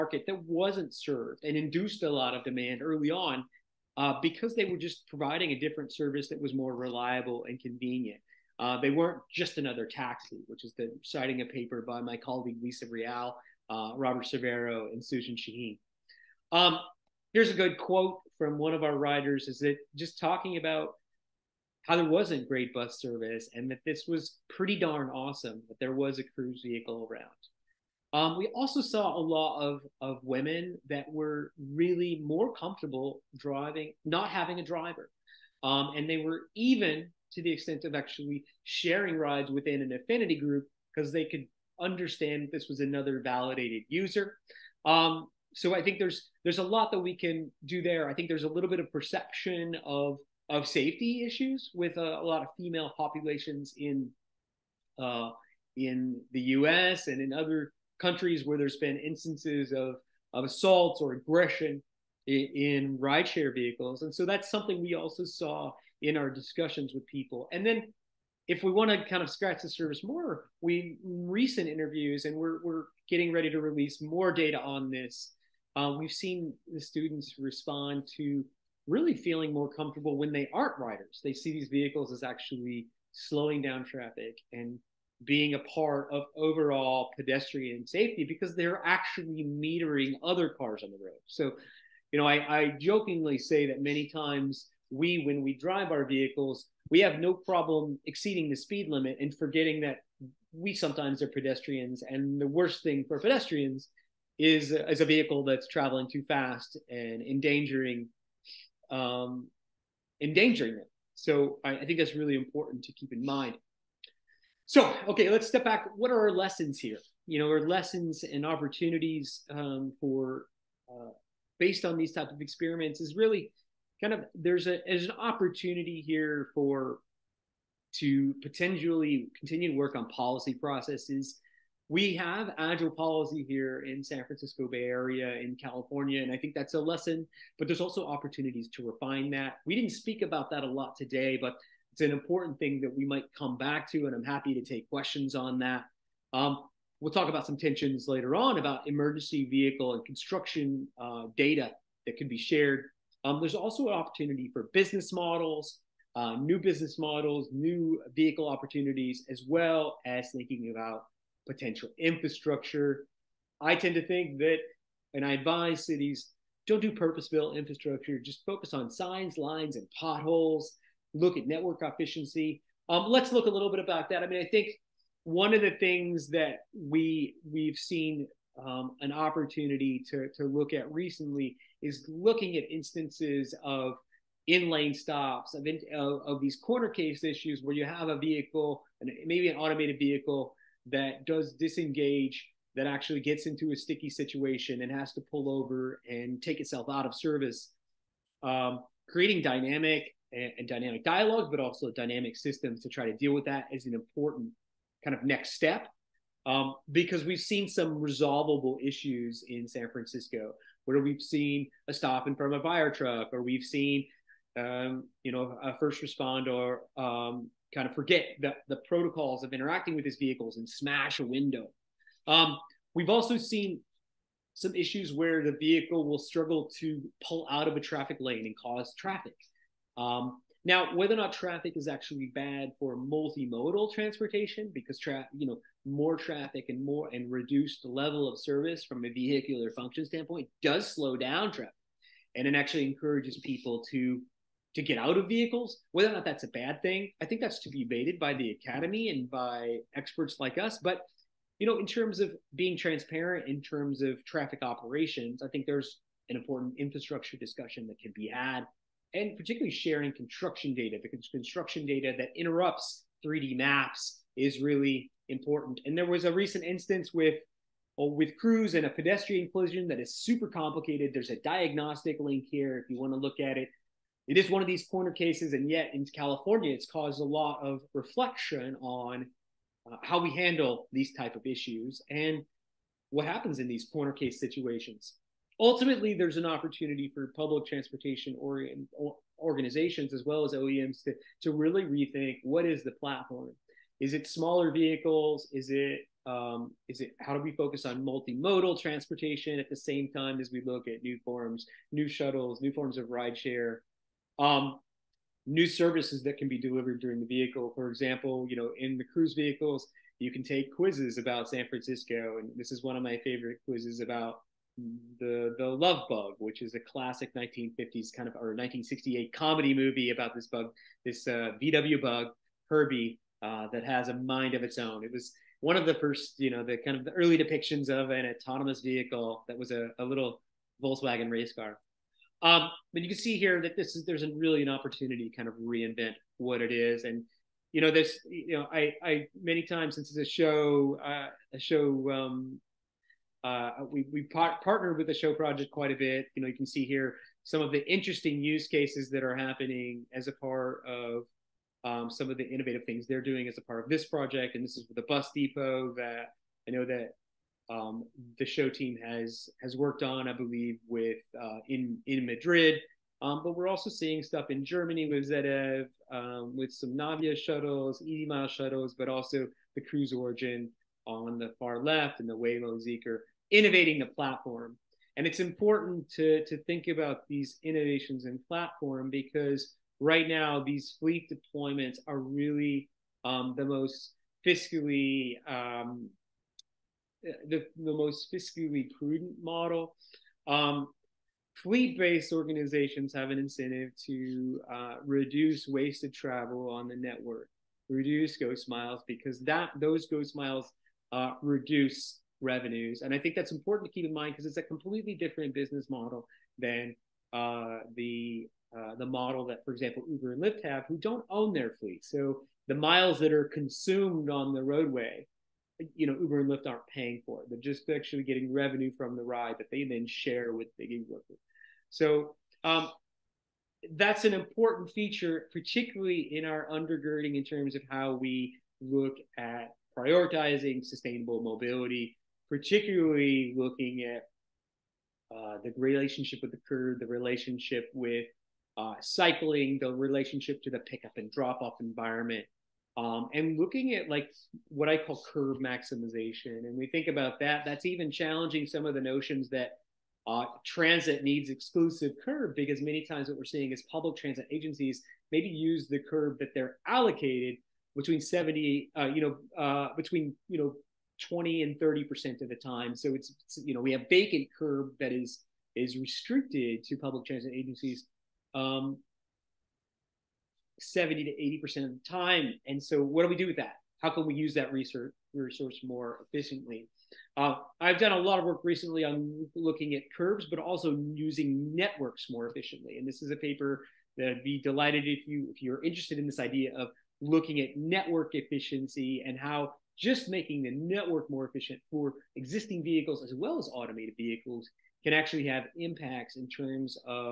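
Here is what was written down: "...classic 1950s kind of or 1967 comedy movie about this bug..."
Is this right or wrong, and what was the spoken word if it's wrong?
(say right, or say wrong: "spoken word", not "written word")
wrong: "1968", not "1967".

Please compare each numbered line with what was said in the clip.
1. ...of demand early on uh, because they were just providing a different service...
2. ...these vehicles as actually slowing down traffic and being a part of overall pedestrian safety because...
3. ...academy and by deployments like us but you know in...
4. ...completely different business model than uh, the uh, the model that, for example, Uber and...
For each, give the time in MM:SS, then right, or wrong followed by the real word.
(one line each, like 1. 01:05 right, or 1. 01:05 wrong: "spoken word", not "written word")
1. 00:02 right
2. 01:21 right
3. 04:08 wrong: "experts", not "deployments"
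4. 06:44 right.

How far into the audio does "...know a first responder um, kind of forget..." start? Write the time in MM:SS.
03:35.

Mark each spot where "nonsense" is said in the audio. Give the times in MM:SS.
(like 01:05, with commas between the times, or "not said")
not said.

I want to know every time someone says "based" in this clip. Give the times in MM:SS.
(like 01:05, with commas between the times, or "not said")
02:01, 06:31.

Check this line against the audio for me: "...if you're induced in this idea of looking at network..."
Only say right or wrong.
wrong.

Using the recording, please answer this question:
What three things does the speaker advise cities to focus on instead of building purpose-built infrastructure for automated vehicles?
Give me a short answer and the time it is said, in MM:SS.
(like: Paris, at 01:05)
Signs, lines, and potholes, at 02:48.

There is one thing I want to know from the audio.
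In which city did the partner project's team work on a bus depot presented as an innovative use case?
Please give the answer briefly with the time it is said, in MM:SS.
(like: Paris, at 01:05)
Madrid, at 06:02.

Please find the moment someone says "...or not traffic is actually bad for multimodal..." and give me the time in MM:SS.
03:51.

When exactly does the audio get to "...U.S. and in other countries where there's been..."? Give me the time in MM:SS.
00:56.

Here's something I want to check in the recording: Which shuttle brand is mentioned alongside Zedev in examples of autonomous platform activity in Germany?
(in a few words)
Navya.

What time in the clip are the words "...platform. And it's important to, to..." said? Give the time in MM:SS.
06:14.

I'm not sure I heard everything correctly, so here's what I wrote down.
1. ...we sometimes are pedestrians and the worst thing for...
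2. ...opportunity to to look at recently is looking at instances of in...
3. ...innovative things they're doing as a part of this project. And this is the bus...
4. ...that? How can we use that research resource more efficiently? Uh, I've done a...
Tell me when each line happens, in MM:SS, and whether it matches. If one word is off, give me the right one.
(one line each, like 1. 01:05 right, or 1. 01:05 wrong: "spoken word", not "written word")
1. 01:40 right
2. 02:59 right
3. 05:52 right
4. 07:53 right.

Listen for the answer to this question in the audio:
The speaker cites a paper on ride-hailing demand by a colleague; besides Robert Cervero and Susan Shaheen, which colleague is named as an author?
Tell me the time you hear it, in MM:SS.
00:12.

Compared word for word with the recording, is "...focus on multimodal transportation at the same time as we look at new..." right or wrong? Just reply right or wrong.
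right.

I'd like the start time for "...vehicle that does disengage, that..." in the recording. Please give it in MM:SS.
03:09.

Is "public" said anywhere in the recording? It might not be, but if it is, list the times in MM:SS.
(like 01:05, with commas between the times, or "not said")
04:47, 07:33, 07:46.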